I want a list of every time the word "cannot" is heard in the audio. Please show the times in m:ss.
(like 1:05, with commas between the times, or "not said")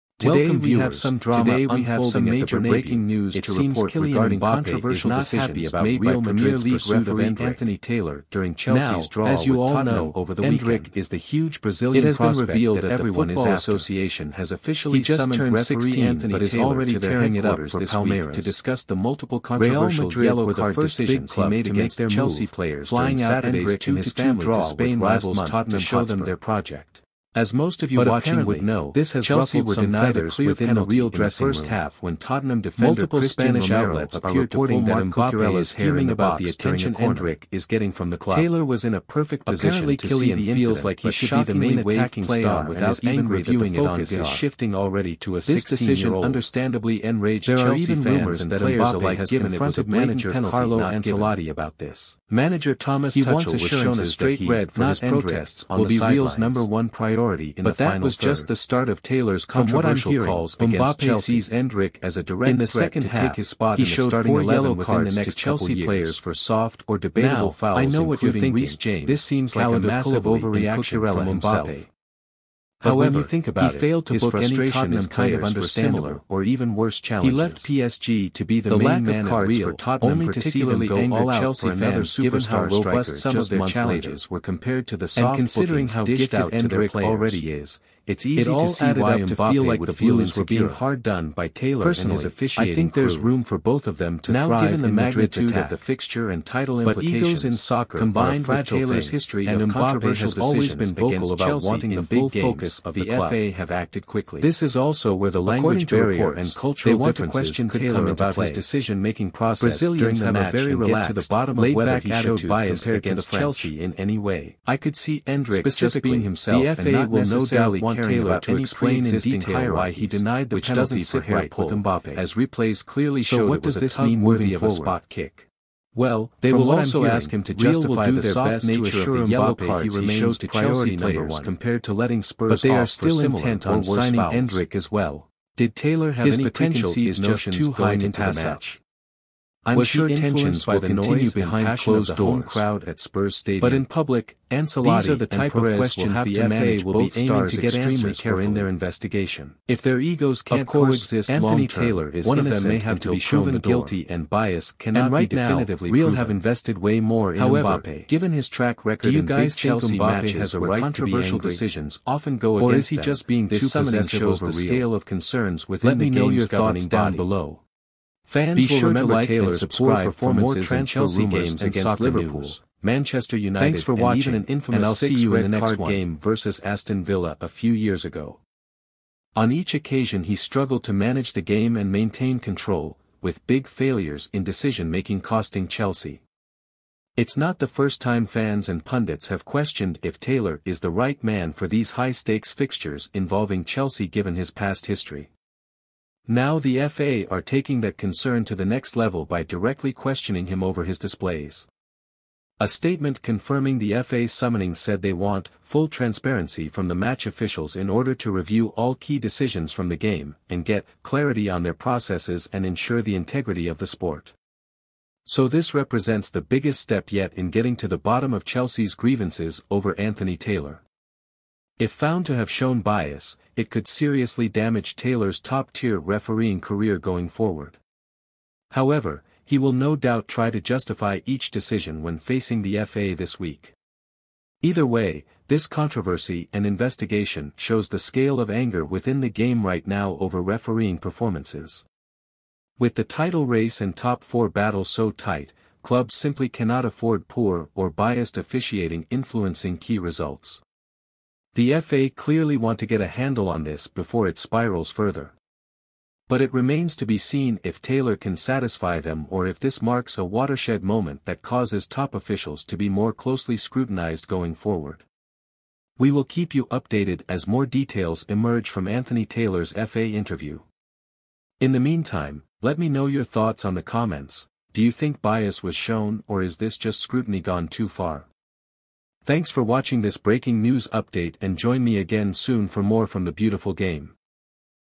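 2:34, 4:06.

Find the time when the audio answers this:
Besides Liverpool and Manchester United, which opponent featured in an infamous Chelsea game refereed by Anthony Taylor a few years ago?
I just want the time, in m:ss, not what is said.
2:56.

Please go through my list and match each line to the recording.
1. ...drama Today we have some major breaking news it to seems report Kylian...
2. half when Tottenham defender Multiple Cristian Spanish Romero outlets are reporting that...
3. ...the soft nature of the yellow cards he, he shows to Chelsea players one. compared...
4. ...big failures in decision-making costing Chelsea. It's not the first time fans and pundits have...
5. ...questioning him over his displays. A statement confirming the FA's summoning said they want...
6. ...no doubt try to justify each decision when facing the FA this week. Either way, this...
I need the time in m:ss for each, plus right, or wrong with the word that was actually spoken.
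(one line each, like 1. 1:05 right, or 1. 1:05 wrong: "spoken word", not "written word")
1. 0:01 right
2. 0:31 right
3. 2:08 right
4. 3:03 right
5. 3:19 right
6. 3:49 right.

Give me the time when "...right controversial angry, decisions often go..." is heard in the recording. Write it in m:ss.
2:40.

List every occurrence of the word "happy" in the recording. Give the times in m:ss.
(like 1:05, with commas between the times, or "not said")
0:05.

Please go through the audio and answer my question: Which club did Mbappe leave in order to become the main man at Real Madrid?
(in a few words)
PSG.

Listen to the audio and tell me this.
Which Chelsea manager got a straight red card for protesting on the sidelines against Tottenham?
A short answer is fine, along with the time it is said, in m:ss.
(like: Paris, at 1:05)
Thomas Tuchel, at 0:52.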